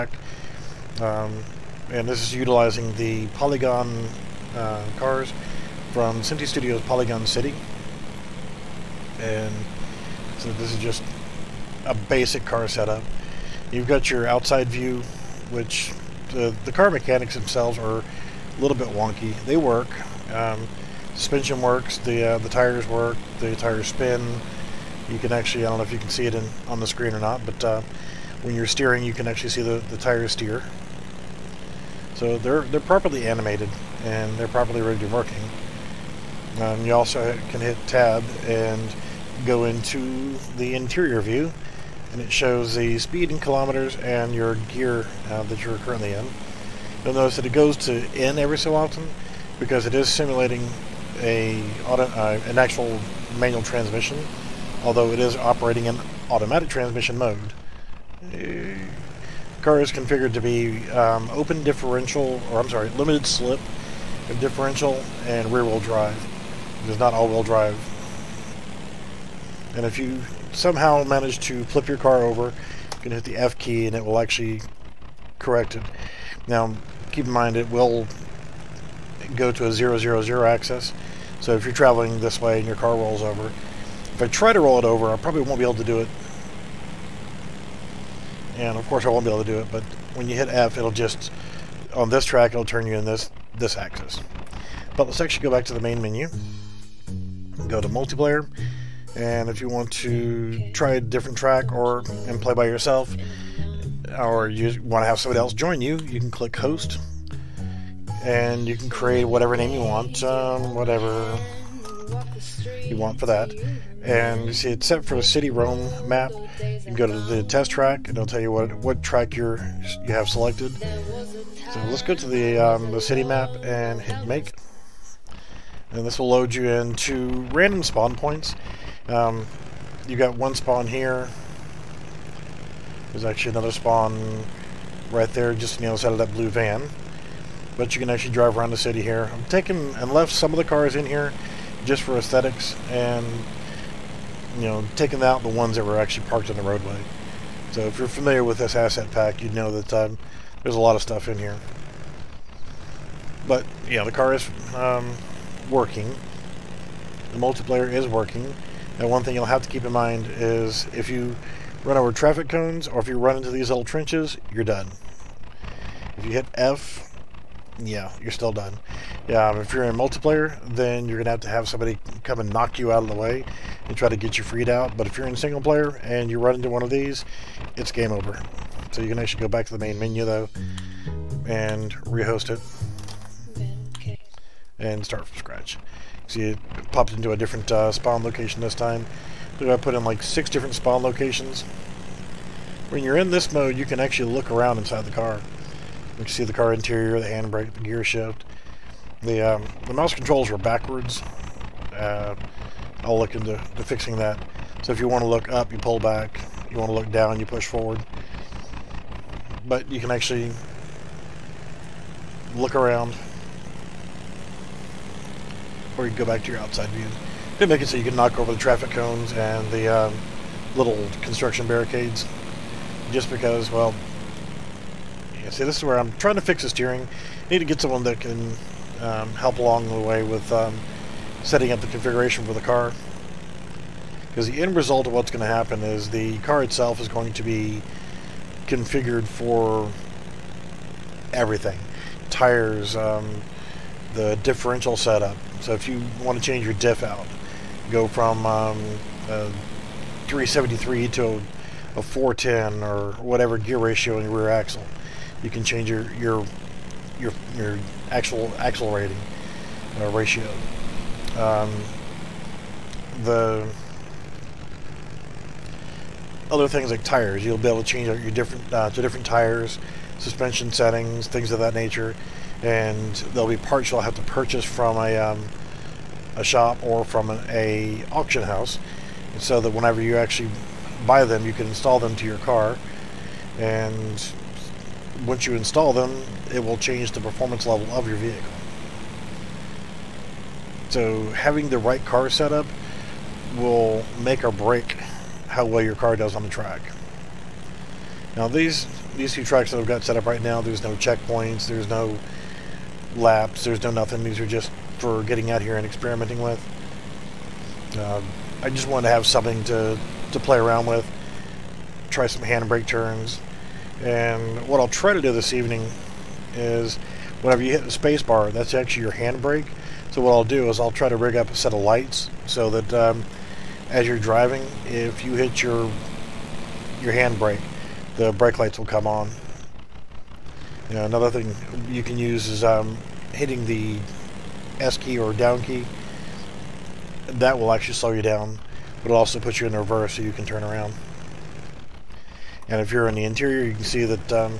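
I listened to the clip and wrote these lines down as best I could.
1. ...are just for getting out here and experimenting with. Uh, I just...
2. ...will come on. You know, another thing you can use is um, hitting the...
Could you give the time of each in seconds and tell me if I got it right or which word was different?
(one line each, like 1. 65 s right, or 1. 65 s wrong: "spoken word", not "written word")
1. 304 s right
2. 328 s right.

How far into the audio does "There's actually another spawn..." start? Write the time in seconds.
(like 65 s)
133 s.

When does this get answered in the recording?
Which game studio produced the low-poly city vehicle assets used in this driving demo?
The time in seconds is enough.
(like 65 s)
6 s.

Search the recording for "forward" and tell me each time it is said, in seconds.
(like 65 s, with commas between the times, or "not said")
207 s.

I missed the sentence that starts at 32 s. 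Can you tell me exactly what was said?
So they're, they're properly animated and they're properly rigged and working.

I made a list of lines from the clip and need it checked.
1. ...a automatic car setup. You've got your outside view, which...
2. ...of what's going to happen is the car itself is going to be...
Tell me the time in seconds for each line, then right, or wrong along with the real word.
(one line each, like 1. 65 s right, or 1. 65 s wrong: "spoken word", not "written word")
1. 11 s wrong: "basic", not "automatic"
2. 235 s right.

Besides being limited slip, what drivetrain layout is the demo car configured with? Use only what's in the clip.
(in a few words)
rear-wheel drive.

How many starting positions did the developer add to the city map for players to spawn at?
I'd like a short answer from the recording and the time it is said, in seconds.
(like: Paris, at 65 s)
6, at 190 s.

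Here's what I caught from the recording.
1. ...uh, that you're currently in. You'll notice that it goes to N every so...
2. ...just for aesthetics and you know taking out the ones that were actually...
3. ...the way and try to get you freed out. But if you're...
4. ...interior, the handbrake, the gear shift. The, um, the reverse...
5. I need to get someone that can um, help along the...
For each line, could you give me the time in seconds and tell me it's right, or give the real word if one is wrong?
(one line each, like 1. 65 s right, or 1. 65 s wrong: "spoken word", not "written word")
1. 45 s right
2. 141 s right
3. 173 s right
4. 196 s wrong: "mouse", not "reverse"
5. 227 s right.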